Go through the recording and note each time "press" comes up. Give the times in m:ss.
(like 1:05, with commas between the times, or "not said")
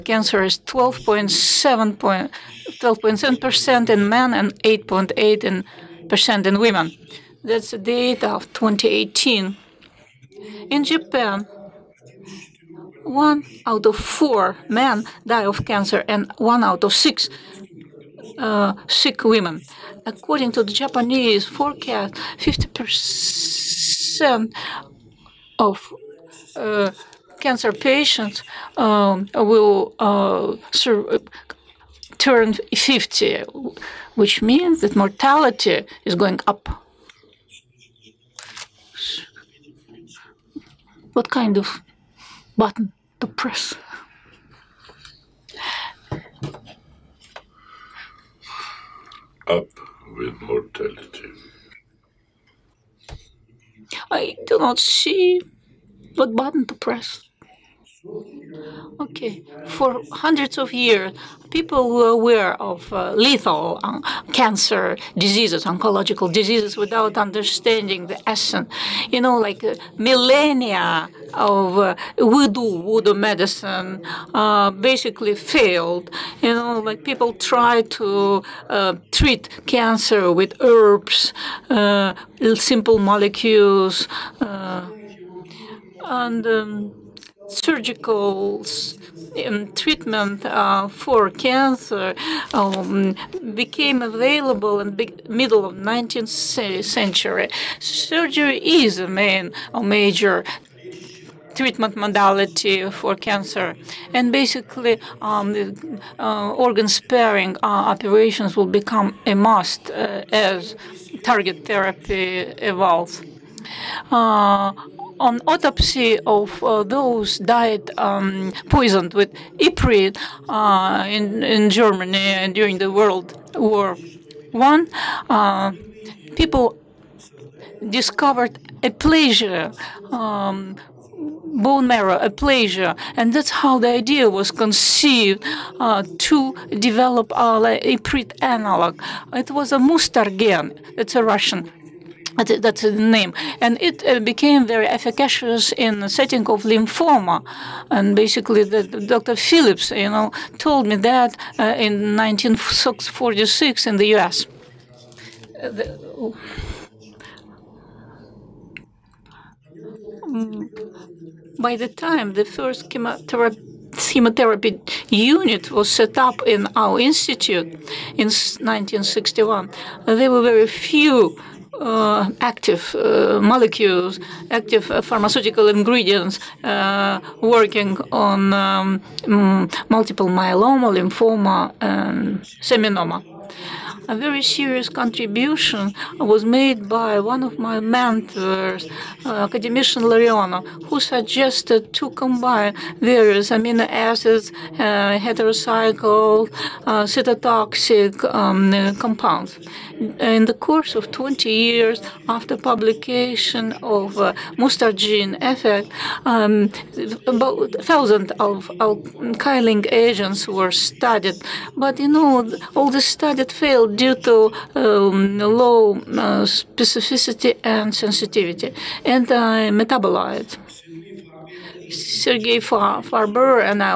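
0:43, 0:56.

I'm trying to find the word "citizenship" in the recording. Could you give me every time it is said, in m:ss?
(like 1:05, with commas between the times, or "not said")
not said.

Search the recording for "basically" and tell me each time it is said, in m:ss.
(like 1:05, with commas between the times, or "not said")
1:14, 1:44, 2:28.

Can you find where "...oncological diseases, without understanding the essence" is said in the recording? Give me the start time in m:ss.
1:05.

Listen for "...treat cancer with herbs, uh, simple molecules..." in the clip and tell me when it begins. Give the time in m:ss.
1:19.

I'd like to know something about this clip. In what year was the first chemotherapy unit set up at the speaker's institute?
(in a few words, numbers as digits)
1961.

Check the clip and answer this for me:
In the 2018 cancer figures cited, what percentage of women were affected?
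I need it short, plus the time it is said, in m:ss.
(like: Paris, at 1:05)
8.8%, at 0:04.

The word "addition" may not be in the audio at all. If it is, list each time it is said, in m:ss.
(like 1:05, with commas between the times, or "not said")
not said.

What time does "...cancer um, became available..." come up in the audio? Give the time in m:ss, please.
1:31.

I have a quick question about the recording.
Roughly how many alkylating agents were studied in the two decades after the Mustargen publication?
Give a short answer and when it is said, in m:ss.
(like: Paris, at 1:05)
1,000, at 3:27.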